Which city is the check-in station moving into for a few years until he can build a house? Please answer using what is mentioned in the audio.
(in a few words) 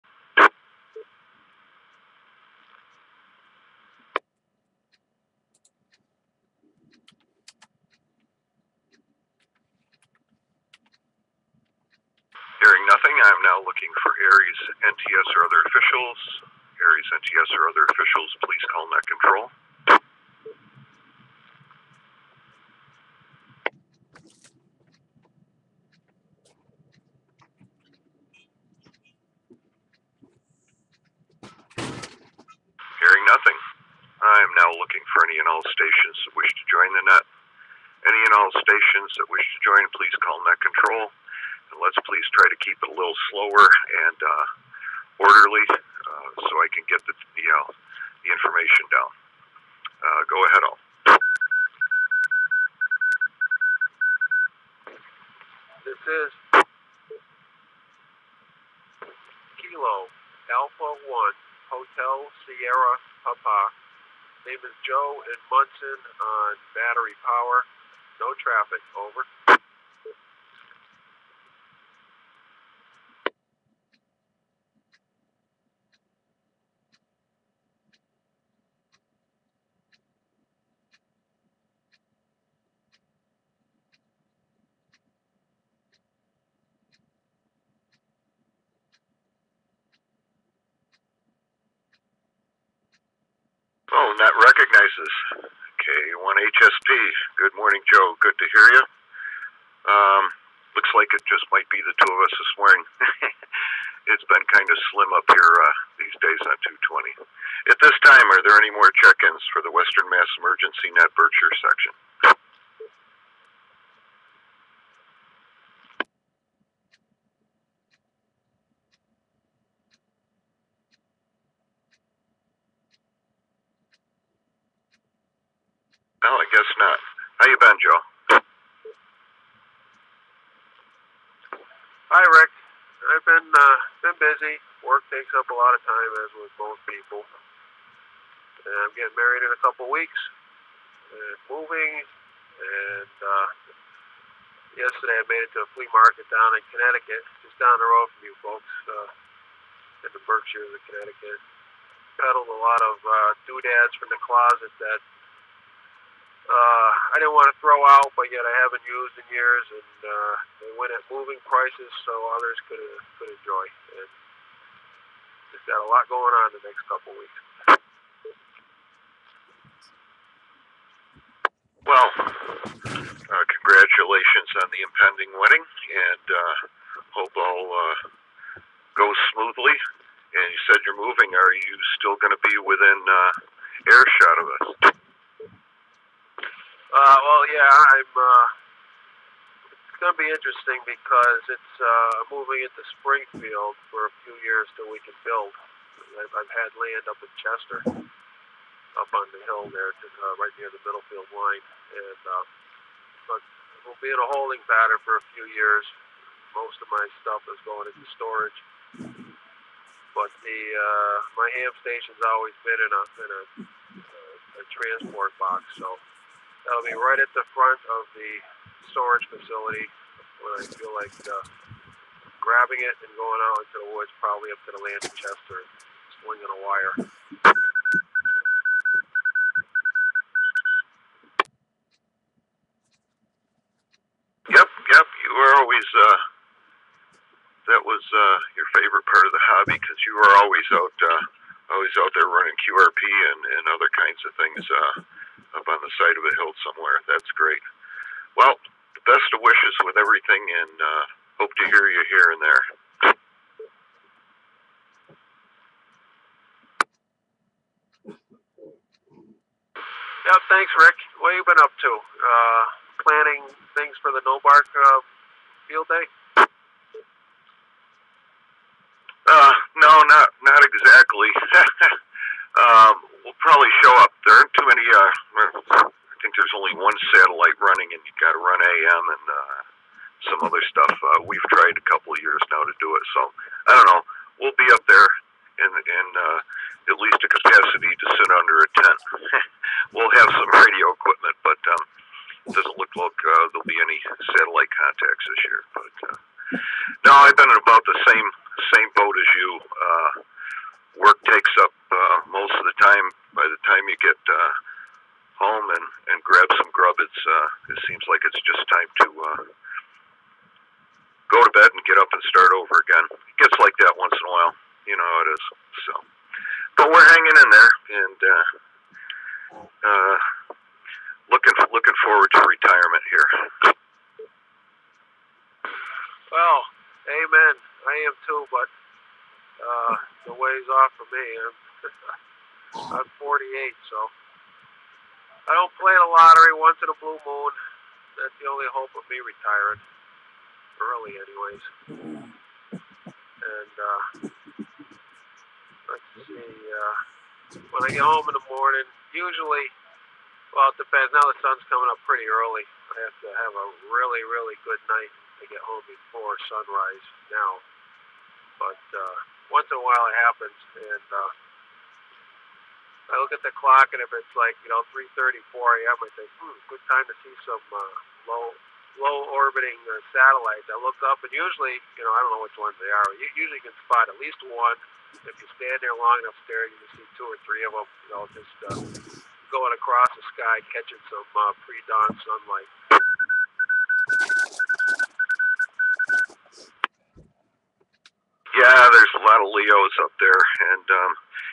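Springfield.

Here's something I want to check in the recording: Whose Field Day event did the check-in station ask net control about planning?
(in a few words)
NoBARC.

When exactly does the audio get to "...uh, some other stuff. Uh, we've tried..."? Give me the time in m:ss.
4:39.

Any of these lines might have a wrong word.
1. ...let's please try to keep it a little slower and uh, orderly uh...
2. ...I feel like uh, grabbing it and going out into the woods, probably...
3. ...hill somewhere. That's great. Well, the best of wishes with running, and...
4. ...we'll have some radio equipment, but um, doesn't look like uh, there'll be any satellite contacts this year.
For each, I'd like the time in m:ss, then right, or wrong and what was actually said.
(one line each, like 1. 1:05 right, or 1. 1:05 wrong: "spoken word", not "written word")
1. 0:41 right
2. 3:40 right
3. 4:06 wrong: "everything", not "running"
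4. 4:49 right.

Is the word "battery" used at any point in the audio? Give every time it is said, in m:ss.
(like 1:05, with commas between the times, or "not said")
1:06.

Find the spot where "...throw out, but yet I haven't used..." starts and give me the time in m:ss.
2:37.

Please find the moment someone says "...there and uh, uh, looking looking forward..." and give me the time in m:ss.
5:17.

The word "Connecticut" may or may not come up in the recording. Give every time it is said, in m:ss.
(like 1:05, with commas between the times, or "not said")
2:26, 2:30.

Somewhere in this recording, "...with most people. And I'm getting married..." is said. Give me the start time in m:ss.
2:16.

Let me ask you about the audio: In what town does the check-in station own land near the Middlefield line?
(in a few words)
Chester.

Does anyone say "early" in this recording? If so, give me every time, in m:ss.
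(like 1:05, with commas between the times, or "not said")
5:40, 5:52.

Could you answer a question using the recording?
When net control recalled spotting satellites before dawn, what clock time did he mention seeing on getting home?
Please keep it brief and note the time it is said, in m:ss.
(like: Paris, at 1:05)
3:34 a.m., at 6:04.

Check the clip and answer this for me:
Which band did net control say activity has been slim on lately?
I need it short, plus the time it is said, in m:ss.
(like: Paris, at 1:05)
220, at 1:46.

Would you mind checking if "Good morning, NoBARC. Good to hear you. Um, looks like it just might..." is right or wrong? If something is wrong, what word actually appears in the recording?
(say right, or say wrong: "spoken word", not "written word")
wrong: "Joe", not "NoBARC".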